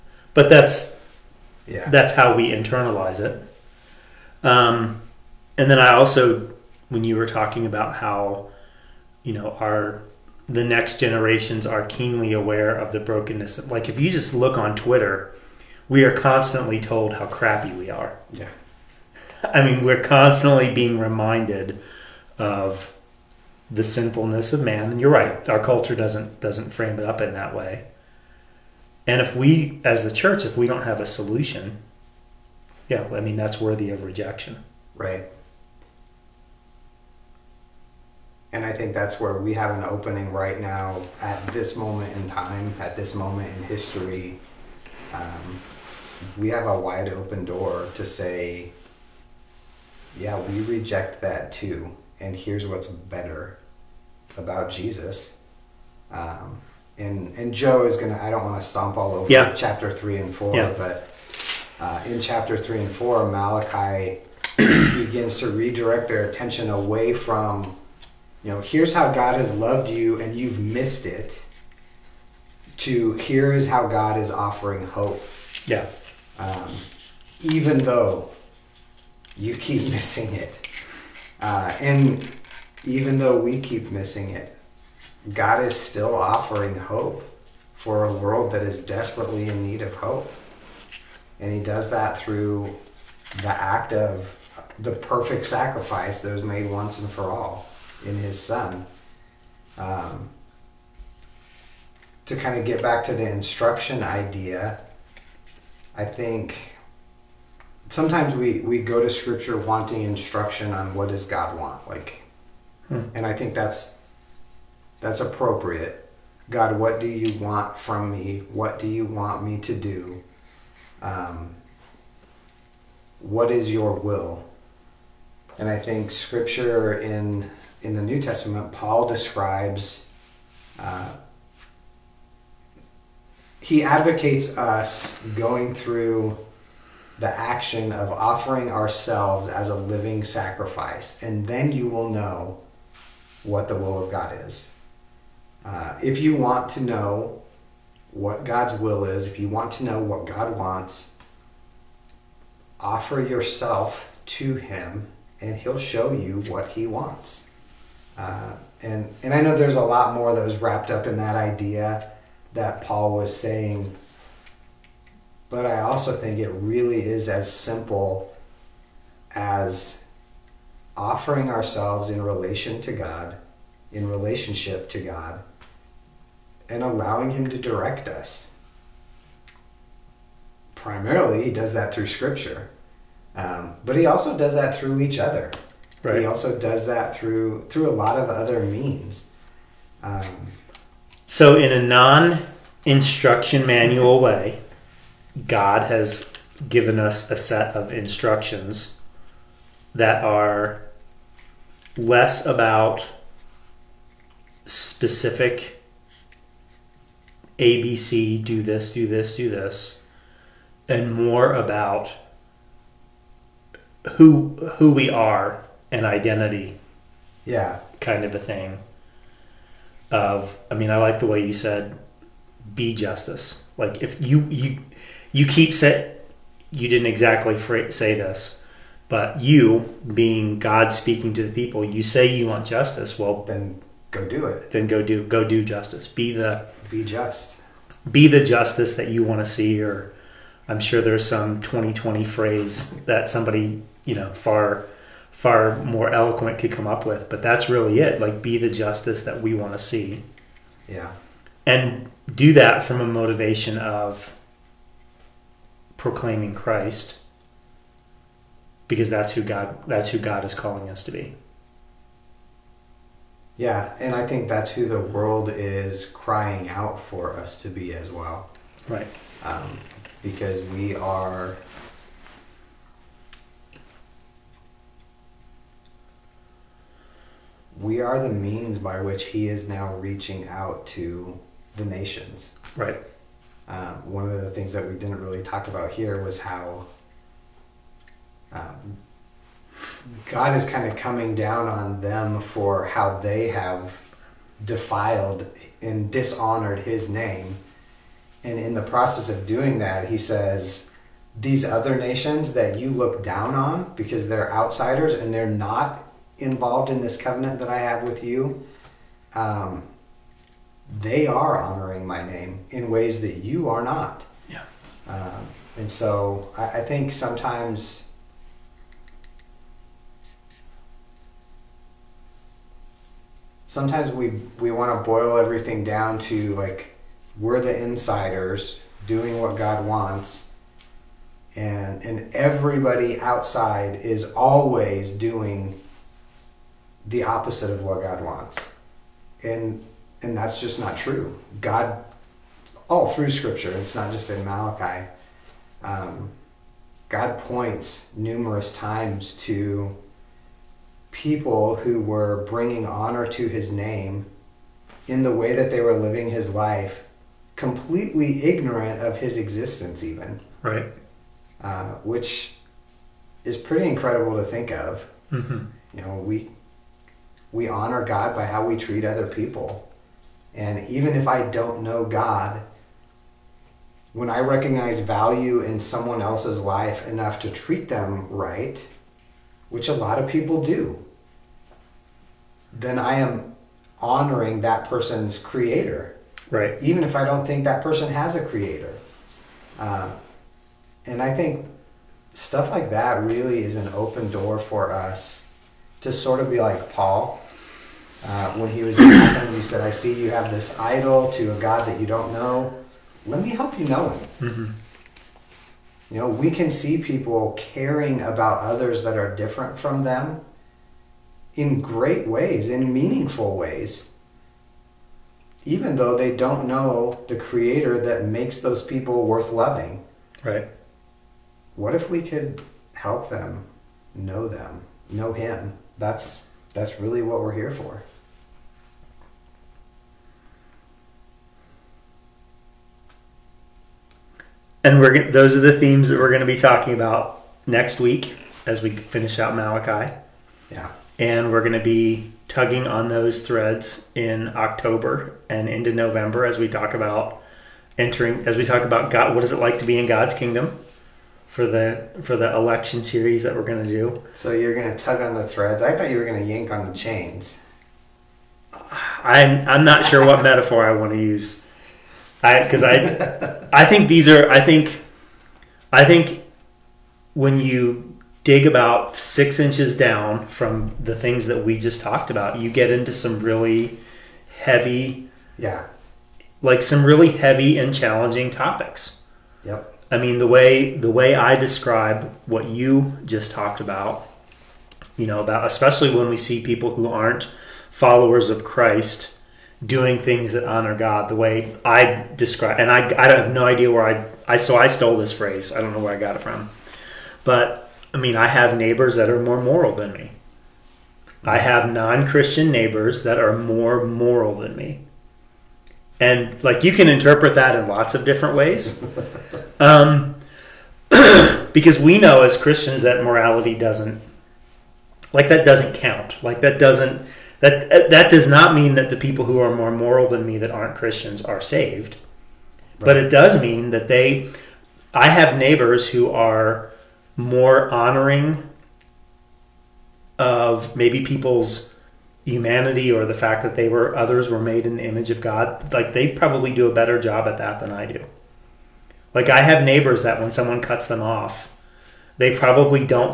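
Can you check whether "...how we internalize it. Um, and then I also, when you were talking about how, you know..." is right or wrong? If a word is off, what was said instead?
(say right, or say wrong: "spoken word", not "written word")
right.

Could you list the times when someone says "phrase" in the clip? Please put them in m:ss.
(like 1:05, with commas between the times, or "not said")
4:02, 8:15.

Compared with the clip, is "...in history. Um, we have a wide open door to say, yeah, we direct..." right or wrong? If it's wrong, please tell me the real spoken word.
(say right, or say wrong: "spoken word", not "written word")
wrong: "reject", not "direct".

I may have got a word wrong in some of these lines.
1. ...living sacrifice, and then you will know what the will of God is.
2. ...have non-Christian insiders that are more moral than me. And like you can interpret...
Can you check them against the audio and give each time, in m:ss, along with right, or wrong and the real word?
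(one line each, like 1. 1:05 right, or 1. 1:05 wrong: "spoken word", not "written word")
1. 2:19 right
2. 8:21 wrong: "neighbors", not "insiders".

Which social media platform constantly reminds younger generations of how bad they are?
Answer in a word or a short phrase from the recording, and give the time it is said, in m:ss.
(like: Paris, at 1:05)
Twitter, at 0:14.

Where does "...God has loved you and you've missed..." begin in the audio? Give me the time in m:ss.
1:09.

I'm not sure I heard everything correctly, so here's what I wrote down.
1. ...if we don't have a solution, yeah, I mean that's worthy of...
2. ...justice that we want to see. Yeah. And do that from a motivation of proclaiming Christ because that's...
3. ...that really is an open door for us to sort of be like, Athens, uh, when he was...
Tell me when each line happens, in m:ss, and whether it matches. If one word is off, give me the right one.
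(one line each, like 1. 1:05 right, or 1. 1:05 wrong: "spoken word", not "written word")
1. 0:30 right
2. 4:08 right
3. 6:32 wrong: "Paul", not "Athens".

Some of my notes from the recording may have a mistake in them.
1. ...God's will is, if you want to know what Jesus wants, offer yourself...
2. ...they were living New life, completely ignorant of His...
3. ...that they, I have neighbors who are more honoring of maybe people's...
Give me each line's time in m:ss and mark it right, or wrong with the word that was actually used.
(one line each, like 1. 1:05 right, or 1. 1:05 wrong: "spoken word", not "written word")
1. 2:28 wrong: "God", not "Jesus"
2. 5:55 wrong: "His", not "New"
3. 8:43 right.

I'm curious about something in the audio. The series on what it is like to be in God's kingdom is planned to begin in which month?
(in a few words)
October.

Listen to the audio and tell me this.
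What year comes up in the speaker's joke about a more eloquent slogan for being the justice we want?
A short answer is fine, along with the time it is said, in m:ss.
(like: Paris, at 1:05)
2020, at 4:01.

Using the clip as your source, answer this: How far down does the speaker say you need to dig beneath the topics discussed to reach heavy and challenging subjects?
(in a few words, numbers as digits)
6 inches.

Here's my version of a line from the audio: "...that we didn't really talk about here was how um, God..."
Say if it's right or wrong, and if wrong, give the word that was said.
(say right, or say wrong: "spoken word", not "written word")
right.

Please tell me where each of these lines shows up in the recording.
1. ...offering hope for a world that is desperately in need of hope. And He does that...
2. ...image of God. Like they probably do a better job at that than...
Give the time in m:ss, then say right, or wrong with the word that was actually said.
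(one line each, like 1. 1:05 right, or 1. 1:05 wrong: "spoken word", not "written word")
1. 1:26 right
2. 8:55 right.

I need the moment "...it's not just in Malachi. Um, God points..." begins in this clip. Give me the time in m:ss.
5:43.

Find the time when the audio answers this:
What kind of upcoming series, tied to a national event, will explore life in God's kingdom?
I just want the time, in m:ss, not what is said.
7:32.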